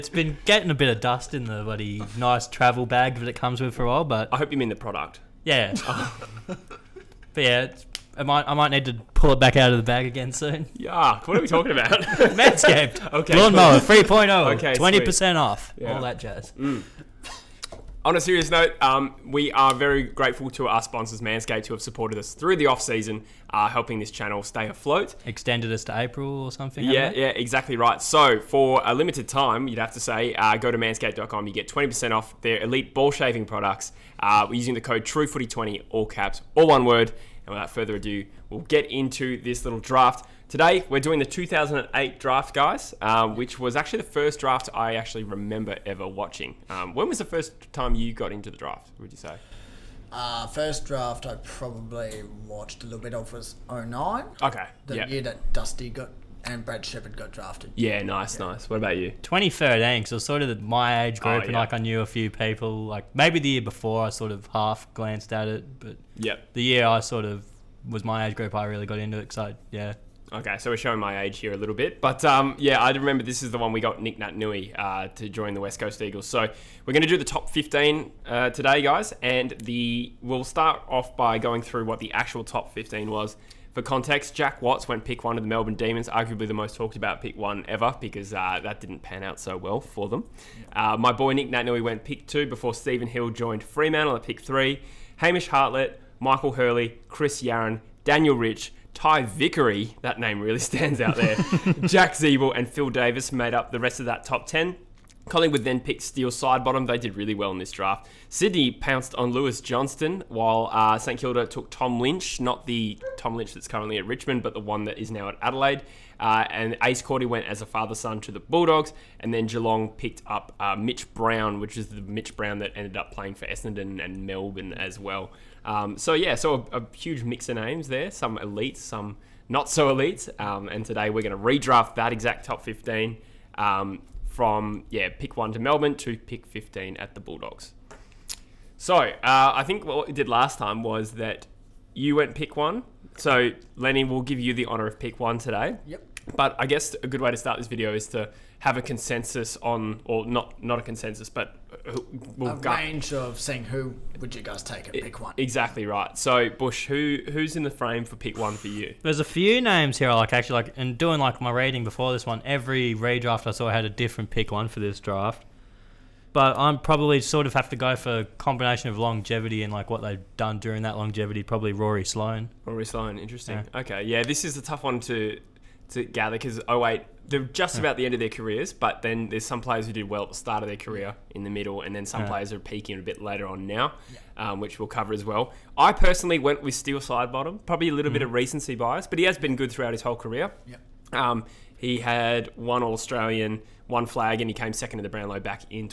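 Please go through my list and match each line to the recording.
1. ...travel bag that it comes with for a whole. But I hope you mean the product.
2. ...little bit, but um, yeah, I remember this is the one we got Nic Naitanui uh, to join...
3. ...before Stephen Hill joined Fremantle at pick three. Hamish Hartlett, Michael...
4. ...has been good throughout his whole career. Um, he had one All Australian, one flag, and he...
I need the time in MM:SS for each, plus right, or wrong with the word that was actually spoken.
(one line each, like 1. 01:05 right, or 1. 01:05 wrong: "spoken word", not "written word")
1. 00:02 wrong: "while", not "whole"
2. 01:11 right
3. 01:32 right
4. 03:09 right.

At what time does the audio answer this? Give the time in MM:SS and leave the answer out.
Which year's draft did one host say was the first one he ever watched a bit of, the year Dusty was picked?
00:53.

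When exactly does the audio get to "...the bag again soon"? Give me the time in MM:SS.
00:09.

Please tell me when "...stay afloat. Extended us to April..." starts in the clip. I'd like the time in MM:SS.
00:24.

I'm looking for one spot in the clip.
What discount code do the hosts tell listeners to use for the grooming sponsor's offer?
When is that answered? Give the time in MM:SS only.
00:35.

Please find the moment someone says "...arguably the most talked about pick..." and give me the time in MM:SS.
01:26.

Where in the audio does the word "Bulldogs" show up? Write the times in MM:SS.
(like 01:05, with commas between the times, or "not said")
01:58, 02:17.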